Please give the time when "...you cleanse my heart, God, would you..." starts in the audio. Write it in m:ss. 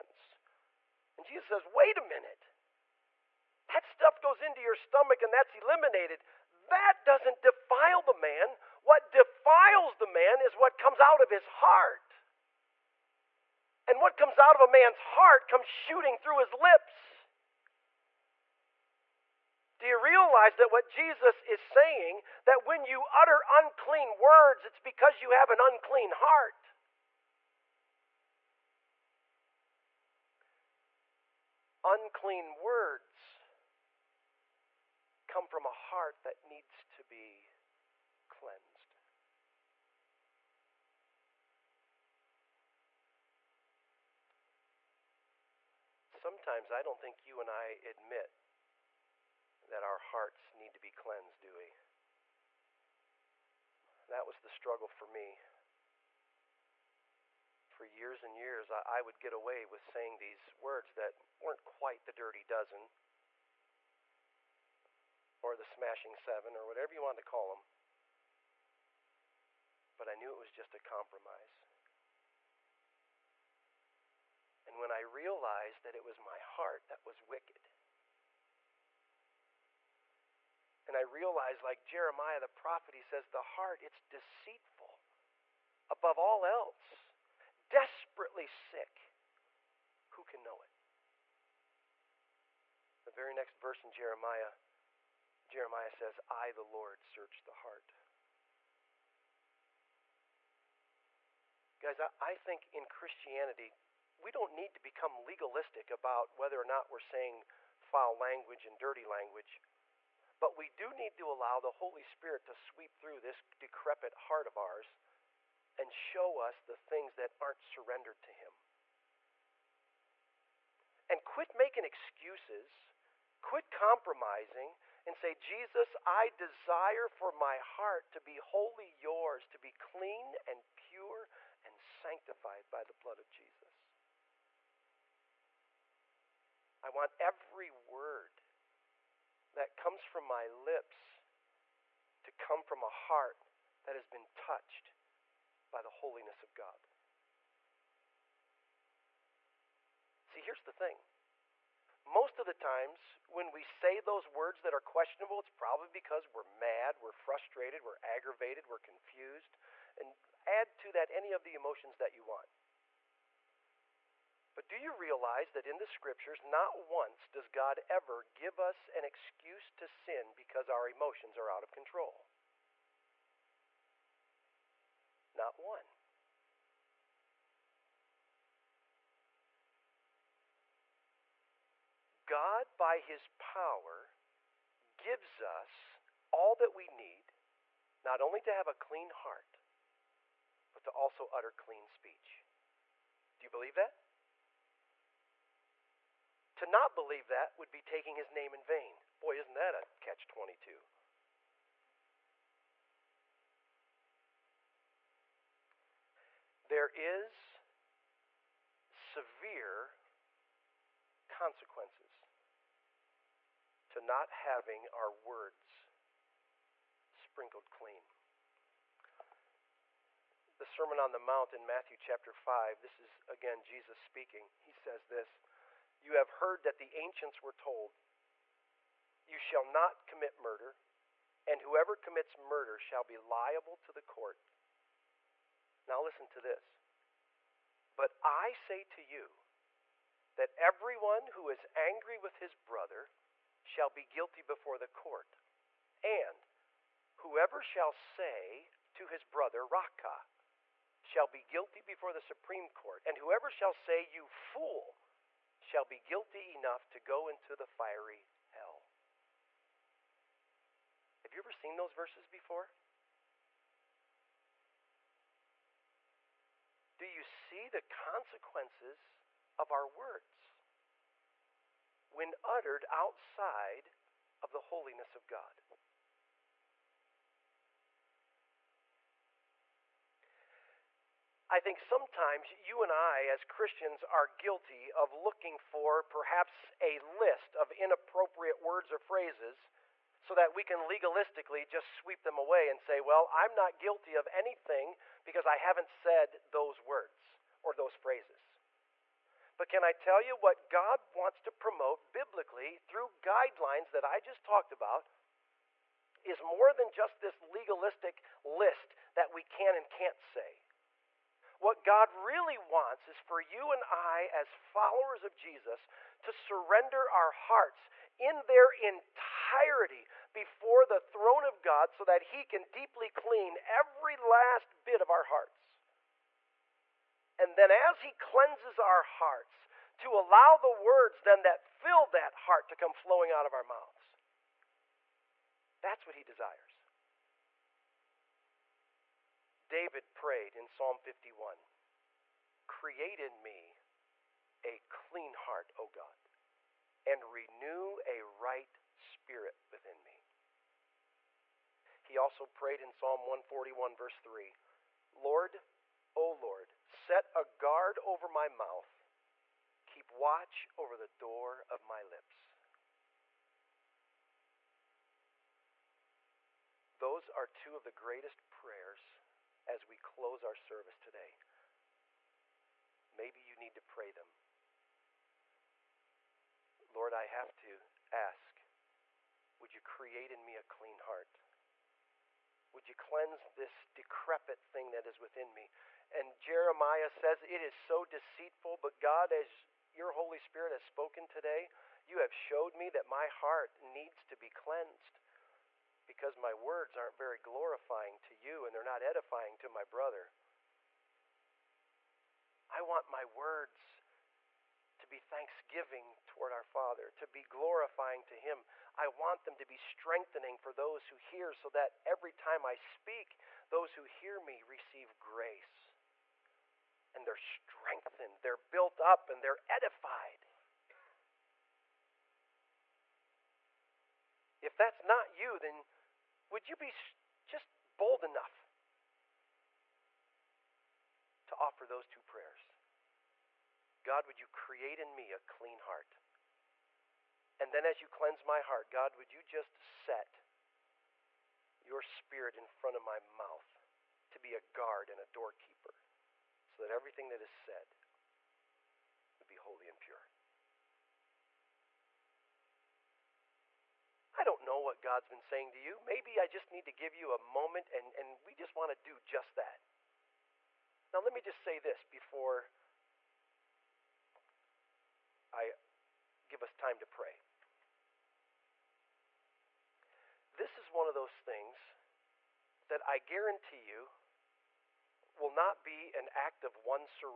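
7:18.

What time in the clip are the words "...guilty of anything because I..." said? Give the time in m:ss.
4:53.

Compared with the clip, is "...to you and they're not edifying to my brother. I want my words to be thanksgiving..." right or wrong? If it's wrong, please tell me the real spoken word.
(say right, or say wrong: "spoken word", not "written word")
right.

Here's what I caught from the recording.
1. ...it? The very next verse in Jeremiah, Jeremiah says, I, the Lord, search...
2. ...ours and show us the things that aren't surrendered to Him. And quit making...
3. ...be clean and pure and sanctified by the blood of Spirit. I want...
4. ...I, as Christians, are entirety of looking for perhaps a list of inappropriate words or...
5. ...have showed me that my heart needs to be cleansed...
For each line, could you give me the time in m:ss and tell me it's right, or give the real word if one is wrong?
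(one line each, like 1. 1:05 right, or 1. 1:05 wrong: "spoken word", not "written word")
1. 1:30 right
2. 1:54 right
3. 2:09 wrong: "Jesus", not "Spirit"
4. 4:42 wrong: "guilty", not "entirety"
5. 6:32 right.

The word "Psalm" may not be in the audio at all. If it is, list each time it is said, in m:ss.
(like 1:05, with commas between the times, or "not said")
5:40, 5:52.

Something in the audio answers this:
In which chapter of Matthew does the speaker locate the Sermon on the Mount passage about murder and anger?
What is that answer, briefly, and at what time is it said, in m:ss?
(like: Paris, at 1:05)
Chapter 5, at 3:41.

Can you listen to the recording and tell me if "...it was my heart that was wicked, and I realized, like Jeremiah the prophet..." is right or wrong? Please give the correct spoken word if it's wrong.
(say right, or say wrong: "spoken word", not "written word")
right.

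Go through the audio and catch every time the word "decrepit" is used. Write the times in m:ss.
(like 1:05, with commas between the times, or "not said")
1:53, 6:23.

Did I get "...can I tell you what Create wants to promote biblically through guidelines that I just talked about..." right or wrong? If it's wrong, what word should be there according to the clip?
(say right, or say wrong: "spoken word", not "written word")
wrong: "God", not "Create".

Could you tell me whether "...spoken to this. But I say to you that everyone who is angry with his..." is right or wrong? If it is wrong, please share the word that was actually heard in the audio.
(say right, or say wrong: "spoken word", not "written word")
wrong: "listen", not "spoken".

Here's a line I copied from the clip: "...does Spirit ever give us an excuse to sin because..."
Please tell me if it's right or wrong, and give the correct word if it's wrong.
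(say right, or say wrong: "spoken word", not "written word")
wrong: "God", not "Spirit".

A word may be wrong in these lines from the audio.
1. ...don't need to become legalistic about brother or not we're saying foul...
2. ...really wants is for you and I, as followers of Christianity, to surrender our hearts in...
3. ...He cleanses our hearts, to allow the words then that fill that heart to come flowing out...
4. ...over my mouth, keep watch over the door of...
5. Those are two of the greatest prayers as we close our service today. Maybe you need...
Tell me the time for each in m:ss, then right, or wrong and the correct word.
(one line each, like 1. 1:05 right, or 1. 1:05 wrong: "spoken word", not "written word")
1. 1:44 wrong: "whether", not "brother"
2. 5:12 wrong: "Jesus", not "Christianity"
3. 5:27 right
4. 5:58 right
5. 6:06 right.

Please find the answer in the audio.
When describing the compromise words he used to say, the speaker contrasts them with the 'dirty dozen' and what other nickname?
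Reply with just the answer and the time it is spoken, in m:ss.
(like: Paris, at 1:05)
the smashing seven, at 1:05.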